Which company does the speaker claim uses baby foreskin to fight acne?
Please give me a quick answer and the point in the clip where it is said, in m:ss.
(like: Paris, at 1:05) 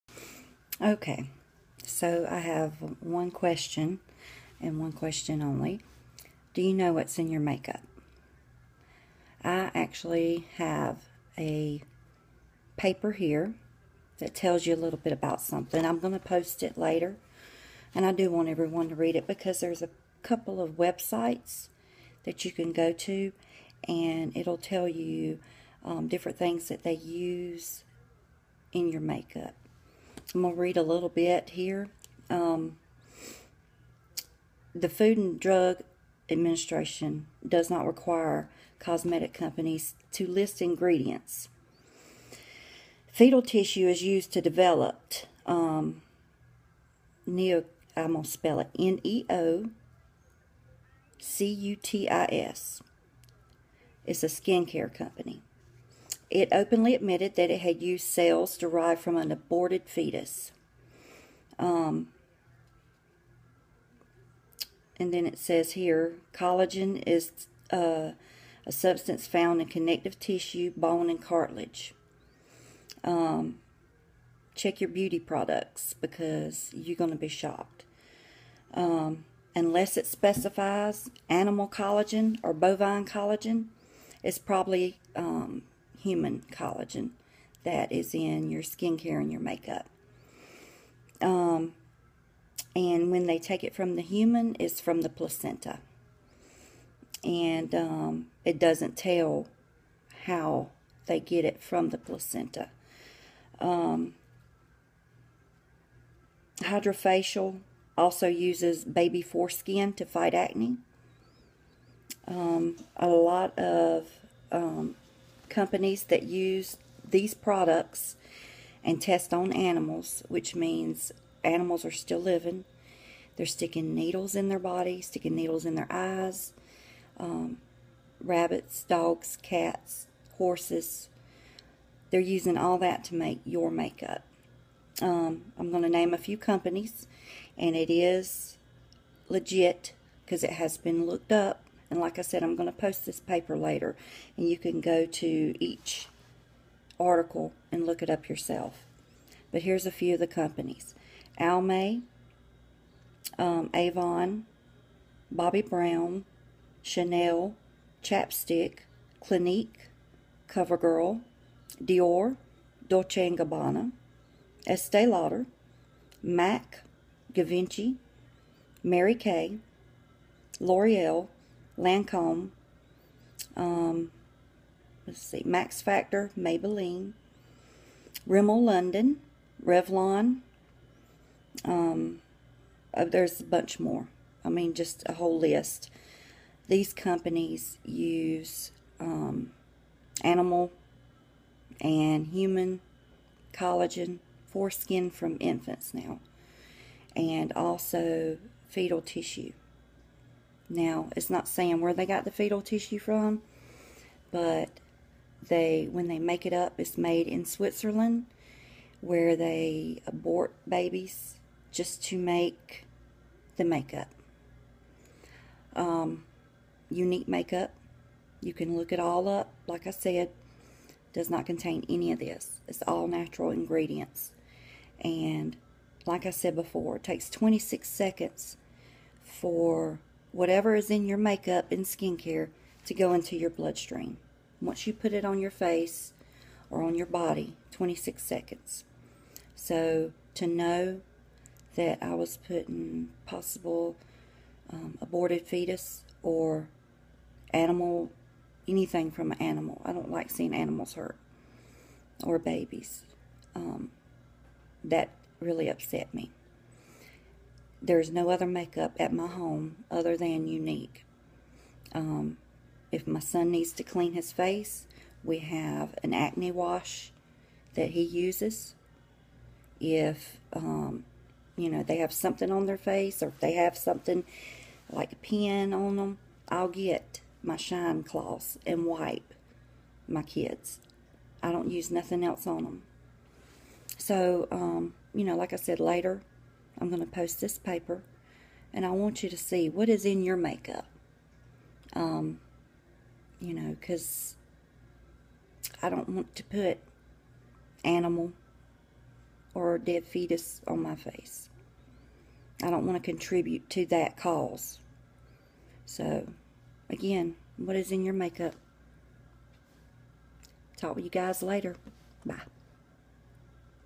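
HydraFacial, at 1:46.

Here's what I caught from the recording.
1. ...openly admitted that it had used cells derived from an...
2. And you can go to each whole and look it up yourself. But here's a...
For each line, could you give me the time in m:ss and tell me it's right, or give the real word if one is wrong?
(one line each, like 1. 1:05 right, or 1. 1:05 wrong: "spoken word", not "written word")
1. 0:56 right
2. 2:24 wrong: "article", not "whole".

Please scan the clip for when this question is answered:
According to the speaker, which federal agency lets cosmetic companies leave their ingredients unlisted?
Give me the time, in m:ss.
0:34.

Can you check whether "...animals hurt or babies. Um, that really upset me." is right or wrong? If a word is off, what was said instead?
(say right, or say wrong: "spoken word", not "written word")
right.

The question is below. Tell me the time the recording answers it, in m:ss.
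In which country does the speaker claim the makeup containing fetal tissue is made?
3:27.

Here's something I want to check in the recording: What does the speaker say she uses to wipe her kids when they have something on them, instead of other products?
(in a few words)
shine cloths.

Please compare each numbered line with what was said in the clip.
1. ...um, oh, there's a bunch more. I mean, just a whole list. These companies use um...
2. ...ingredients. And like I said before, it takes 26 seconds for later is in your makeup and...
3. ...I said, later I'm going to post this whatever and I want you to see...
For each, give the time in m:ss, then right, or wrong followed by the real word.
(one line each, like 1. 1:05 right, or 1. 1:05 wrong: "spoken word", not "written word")
1. 3:01 right
2. 3:43 wrong: "whatever", not "later"
3. 4:45 wrong: "paper", not "whatever".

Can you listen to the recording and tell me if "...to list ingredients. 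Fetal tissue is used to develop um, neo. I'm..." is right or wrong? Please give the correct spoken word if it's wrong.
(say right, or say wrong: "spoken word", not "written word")
right.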